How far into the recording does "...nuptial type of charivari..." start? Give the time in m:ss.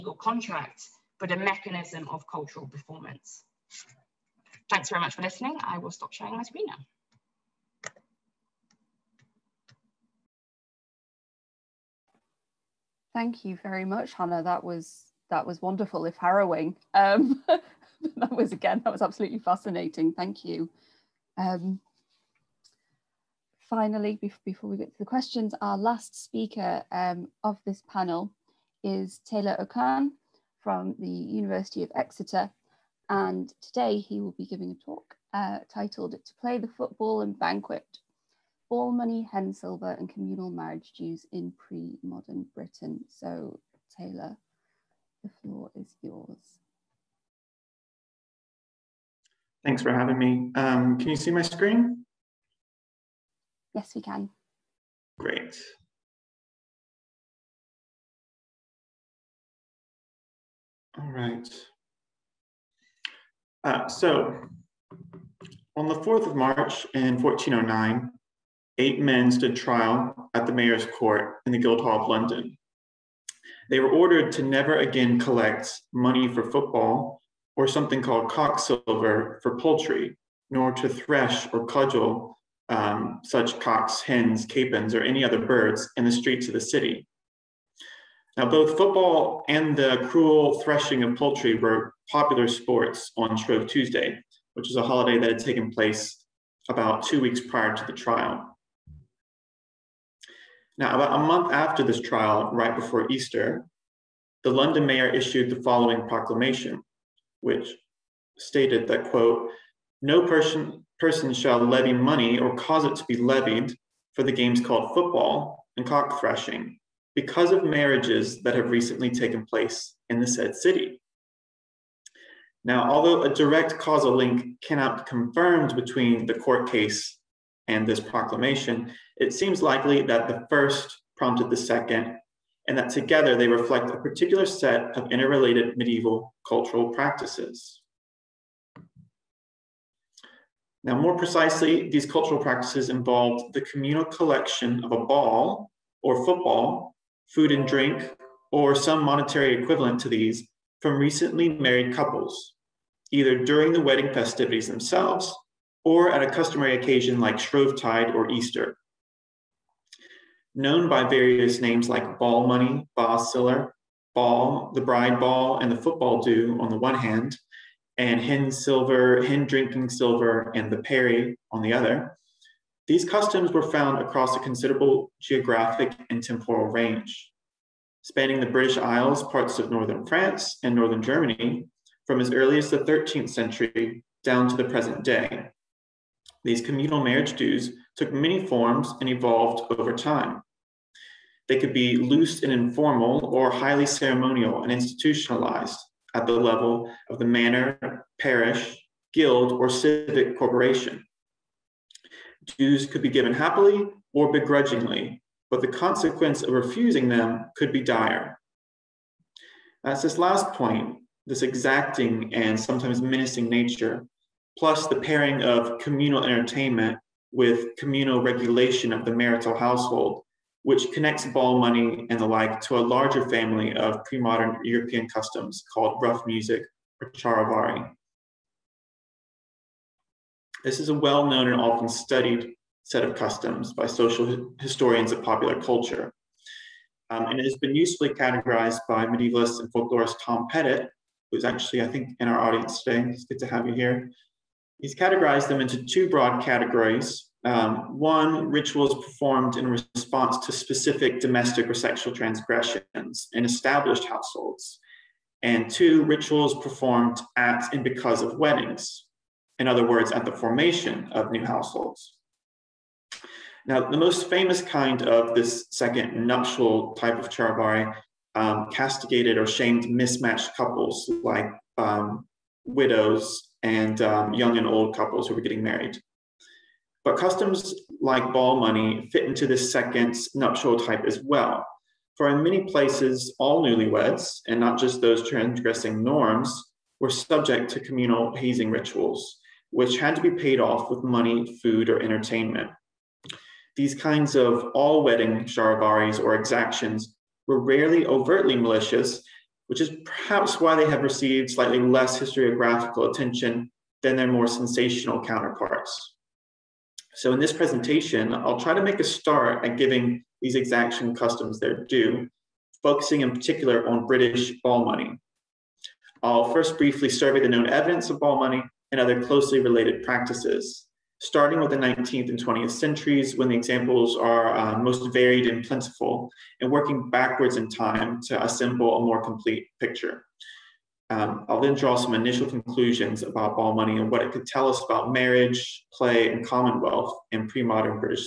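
4:26.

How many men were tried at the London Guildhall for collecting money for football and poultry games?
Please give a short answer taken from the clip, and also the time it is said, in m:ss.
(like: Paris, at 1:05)
8, at 1:08.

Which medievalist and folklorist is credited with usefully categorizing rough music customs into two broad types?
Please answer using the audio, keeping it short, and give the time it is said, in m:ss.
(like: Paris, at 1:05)
Tom Pettitt, at 4:00.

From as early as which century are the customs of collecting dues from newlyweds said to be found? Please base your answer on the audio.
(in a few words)
13th century.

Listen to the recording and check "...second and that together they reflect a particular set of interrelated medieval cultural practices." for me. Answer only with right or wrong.
right.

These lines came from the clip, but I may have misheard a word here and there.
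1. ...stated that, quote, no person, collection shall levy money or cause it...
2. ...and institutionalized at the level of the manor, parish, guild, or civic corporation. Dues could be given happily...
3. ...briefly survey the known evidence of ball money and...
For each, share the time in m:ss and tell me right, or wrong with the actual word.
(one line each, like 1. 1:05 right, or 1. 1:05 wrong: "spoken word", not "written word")
1. 1:48 wrong: "person", not "collection"
2. 3:14 right
3. 5:16 right.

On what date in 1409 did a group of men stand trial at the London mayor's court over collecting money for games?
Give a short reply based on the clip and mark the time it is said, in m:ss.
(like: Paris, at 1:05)
4th of March, at 1:05.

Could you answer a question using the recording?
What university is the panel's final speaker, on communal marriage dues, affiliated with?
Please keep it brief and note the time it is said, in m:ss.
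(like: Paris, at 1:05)
University of Exeter, at 0:31.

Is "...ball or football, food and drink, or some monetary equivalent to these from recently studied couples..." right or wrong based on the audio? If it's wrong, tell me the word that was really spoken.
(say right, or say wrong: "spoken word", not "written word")
wrong: "married", not "studied".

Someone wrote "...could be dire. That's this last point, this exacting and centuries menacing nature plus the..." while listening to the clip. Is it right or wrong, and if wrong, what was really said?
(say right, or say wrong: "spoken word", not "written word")
wrong: "sometimes", not "centuries".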